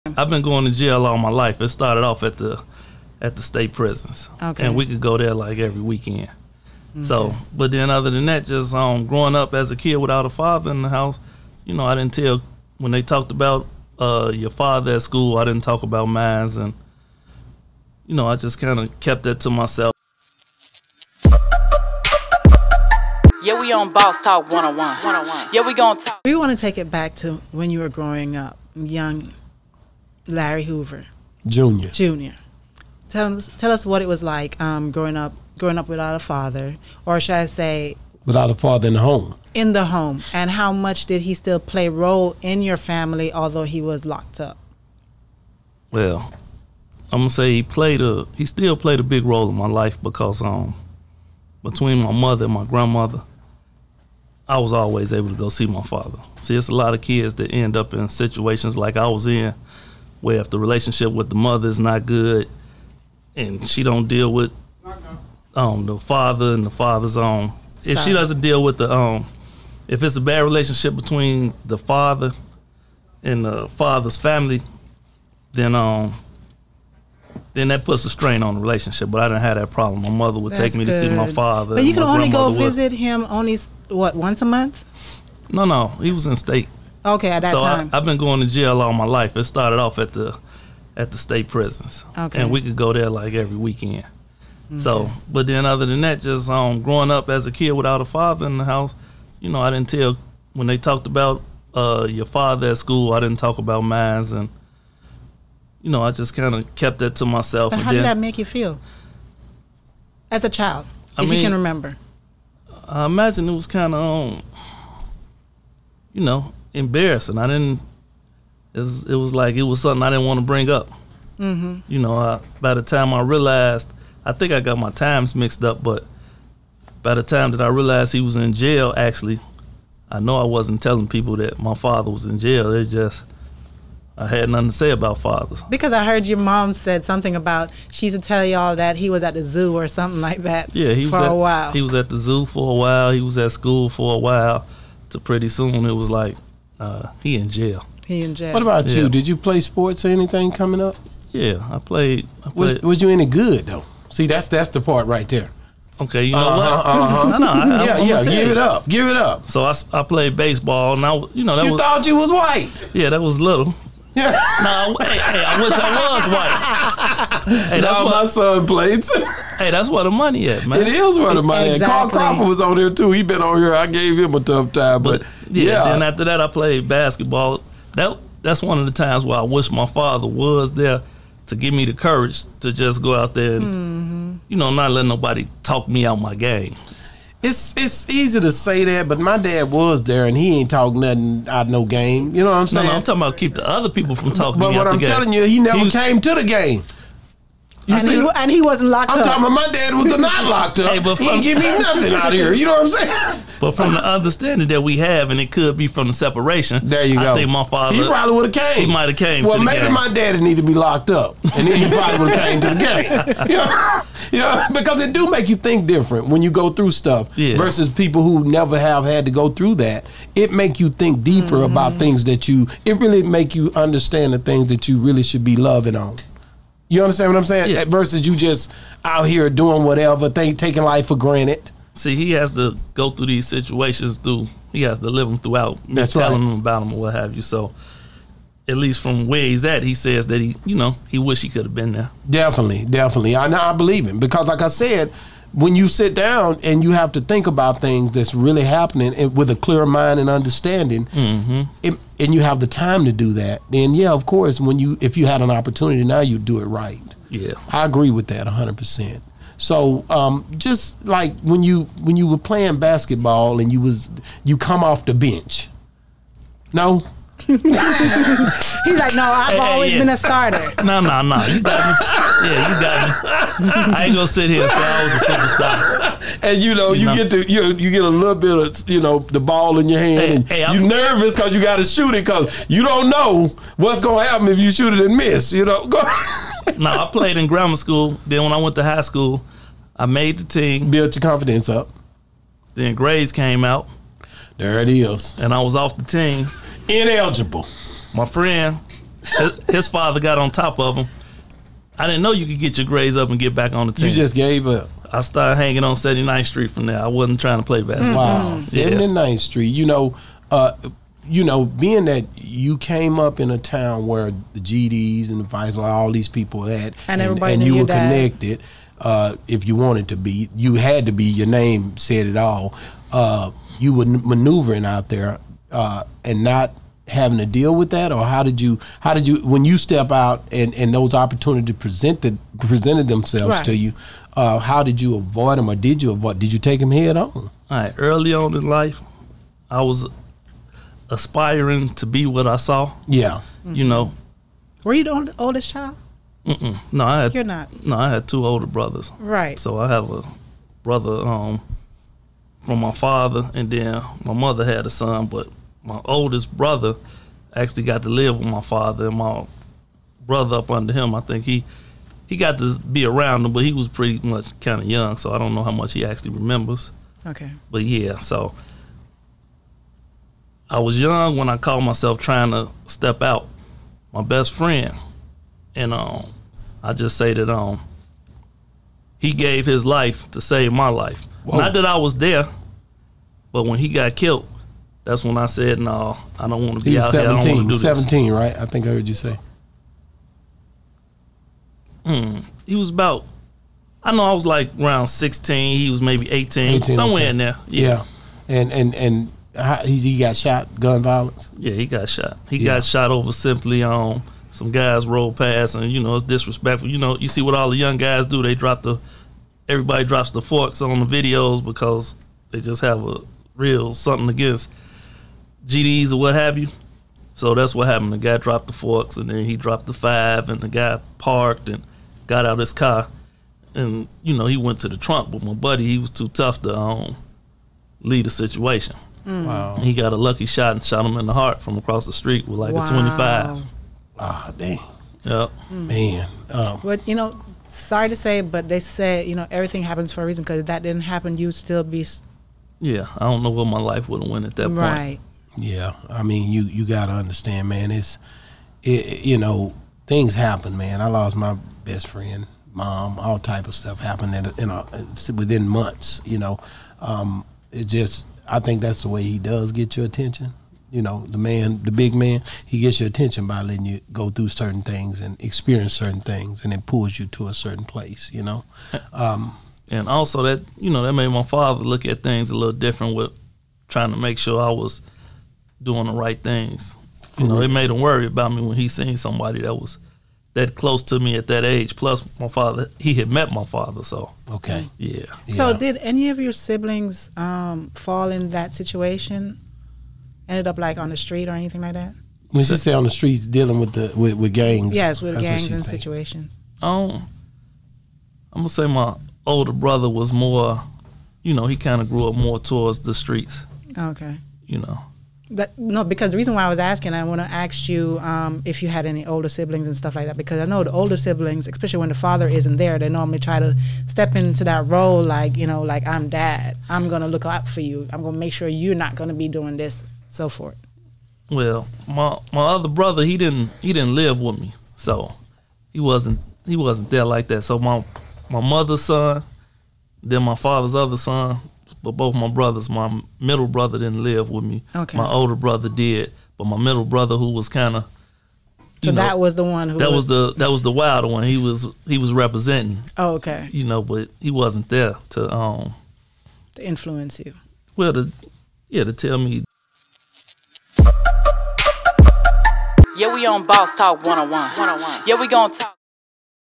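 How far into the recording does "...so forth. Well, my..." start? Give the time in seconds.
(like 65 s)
520 s.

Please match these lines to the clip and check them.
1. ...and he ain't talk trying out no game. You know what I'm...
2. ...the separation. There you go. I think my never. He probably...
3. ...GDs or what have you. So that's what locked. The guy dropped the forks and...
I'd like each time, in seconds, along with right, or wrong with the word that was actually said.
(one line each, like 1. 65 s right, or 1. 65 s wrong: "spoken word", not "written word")
1. 190 s wrong: "nothing", not "trying"
2. 206 s wrong: "father", not "never"
3. 415 s wrong: "happened", not "locked".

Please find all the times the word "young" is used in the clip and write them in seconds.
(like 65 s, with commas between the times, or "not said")
28 s, 364 s, 370 s, 407 s.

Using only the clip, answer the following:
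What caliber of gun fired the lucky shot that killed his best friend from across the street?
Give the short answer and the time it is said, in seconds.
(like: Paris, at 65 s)
25, at 432 s.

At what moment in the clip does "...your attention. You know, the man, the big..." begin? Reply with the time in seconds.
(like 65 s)
459 s.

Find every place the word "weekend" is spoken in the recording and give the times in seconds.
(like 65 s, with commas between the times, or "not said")
5 s, 93 s.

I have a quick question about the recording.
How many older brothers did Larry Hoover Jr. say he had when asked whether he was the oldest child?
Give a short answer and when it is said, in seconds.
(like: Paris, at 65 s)
2, at 348 s.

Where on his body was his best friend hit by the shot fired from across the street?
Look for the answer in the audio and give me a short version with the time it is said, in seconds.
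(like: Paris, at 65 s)
The heart, at 431 s.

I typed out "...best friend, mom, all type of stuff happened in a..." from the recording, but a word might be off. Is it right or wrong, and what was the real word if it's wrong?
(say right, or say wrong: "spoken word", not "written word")
right.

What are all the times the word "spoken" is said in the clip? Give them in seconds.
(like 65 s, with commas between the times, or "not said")
not said.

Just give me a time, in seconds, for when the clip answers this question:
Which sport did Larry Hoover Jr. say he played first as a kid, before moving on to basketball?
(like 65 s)
160 s.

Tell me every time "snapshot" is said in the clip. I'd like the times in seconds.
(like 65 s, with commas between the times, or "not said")
not said.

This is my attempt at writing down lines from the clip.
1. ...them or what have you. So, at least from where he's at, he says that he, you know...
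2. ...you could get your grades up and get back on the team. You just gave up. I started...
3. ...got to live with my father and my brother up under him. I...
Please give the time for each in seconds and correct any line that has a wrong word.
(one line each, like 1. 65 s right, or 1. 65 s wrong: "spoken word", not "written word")
1. 236 s right
2. 302 s right
3. 357 s right.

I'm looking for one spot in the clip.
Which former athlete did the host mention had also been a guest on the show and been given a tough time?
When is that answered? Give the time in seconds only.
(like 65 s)
172 s.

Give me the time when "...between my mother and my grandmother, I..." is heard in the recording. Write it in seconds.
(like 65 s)
51 s.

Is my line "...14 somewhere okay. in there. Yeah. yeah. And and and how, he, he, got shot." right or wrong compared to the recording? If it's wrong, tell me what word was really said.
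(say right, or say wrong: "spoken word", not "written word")
wrong: "18", not "14".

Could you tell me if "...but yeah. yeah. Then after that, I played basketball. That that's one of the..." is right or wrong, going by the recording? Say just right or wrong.
right.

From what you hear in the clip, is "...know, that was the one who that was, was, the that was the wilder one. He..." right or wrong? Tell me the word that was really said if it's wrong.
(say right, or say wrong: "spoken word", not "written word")
right.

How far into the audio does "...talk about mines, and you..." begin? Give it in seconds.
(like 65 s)
103 s.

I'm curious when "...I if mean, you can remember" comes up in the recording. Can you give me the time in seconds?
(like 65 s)
111 s.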